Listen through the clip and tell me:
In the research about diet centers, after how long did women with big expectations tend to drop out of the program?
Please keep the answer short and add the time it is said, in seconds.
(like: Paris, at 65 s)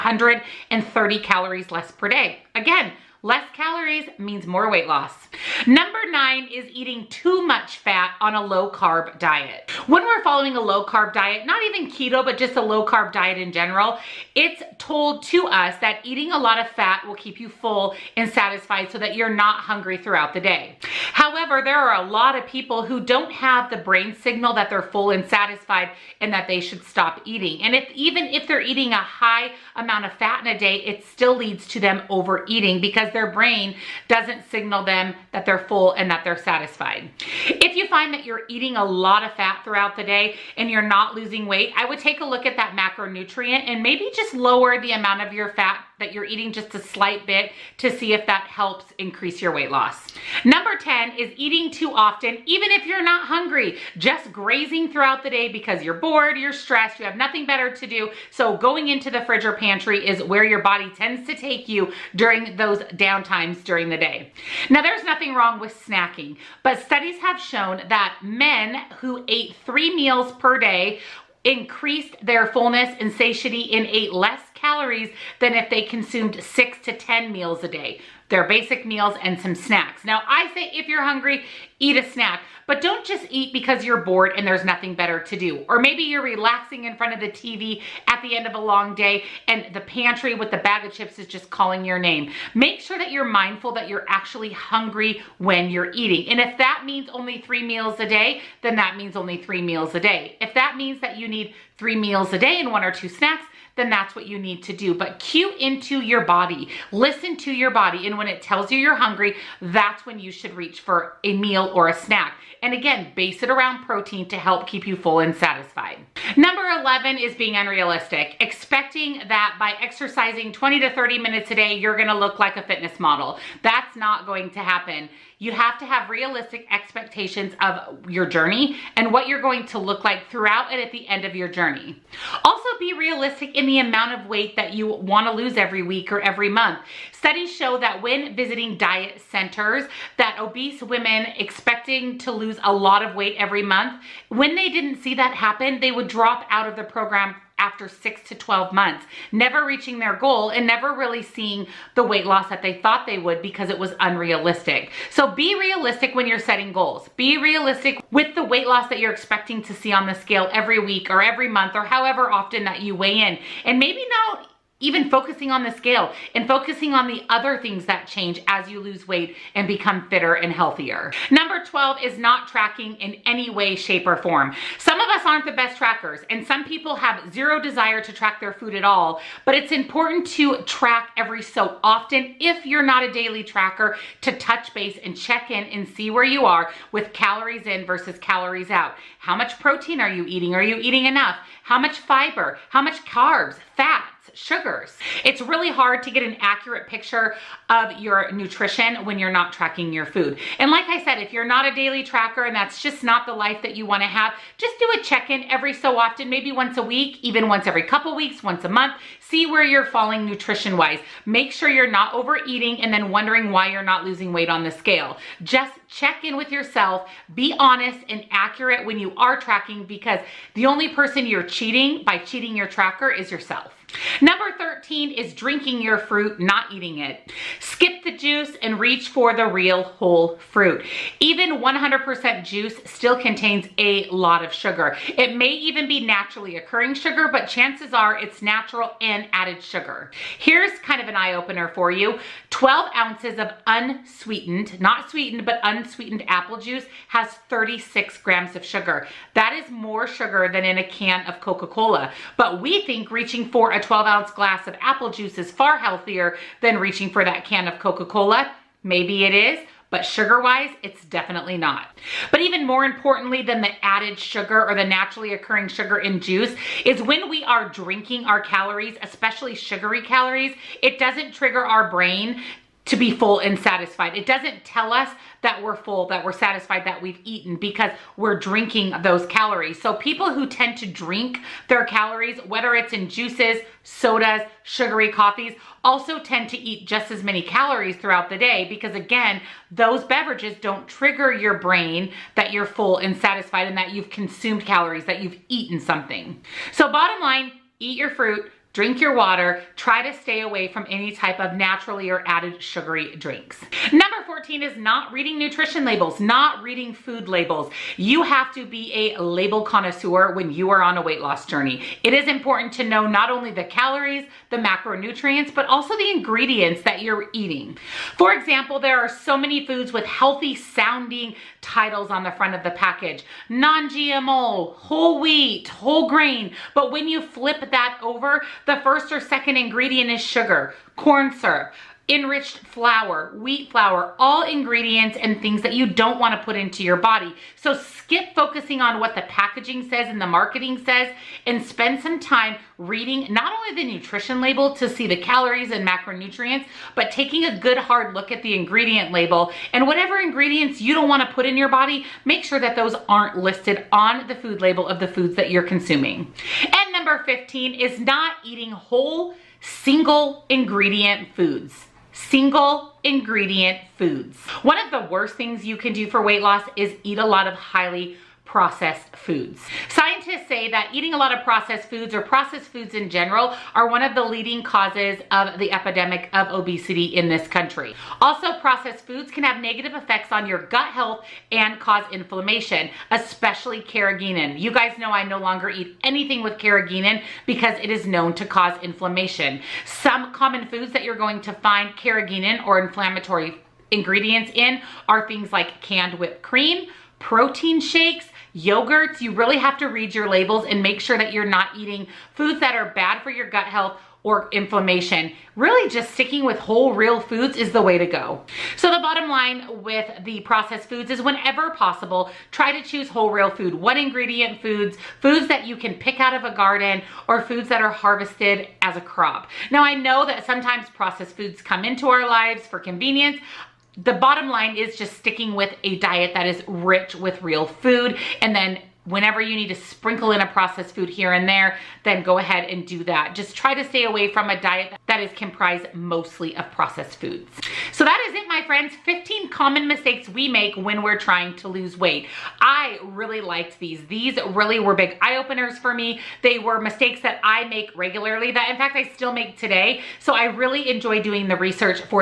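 6 to 12 months, at 147 s.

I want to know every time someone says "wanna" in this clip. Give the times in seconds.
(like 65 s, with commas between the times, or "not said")
134 s, 203 s.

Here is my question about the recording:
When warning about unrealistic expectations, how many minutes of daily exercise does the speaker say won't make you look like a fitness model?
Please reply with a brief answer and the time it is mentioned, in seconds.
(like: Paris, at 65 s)
20 to 30 minutes, at 120 s.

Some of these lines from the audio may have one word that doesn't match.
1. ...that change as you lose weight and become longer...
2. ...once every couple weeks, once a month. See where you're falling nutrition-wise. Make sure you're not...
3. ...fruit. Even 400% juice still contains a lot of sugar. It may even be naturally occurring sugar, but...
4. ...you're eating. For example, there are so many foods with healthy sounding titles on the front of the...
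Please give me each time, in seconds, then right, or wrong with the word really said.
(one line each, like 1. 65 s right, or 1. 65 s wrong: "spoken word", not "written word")
1. 167 s wrong: "fitter", not "longer"
2. 207 s right
3. 230 s wrong: "100", not "400"
4. 317 s right.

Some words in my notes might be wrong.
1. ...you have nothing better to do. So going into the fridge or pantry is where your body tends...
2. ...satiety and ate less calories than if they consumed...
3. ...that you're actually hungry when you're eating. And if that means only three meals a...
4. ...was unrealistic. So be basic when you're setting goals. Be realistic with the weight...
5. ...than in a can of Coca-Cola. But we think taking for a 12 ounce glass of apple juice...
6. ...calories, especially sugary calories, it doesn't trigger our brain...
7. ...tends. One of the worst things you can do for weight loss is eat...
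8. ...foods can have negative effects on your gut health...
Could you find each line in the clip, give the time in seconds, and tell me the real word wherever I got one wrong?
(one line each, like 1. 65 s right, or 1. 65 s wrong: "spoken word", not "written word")
1. 56 s right
2. 73 s right
3. 93 s right
4. 153 s wrong: "realistic", not "basic"
5. 250 s wrong: "reaching", not "taking"
6. 268 s right
7. 363 s wrong: "foods", not "tends"
8. 379 s right.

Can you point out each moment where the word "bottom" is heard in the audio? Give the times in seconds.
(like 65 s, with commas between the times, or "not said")
296 s, 408 s, 424 s.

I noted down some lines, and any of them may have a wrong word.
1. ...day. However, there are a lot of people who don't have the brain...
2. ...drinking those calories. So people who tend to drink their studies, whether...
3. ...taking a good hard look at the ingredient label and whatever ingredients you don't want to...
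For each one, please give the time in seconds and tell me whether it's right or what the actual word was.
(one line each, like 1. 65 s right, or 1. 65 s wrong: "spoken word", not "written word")
1. 20 s right
2. 278 s wrong: "calories", not "studies"
3. 347 s right.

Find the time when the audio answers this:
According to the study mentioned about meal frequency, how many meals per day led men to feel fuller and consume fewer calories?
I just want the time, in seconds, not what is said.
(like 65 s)
69 s.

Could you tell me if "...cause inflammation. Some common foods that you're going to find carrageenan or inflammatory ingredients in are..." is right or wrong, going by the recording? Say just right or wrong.
right.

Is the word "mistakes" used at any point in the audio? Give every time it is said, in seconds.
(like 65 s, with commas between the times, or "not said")
439 s, 446 s.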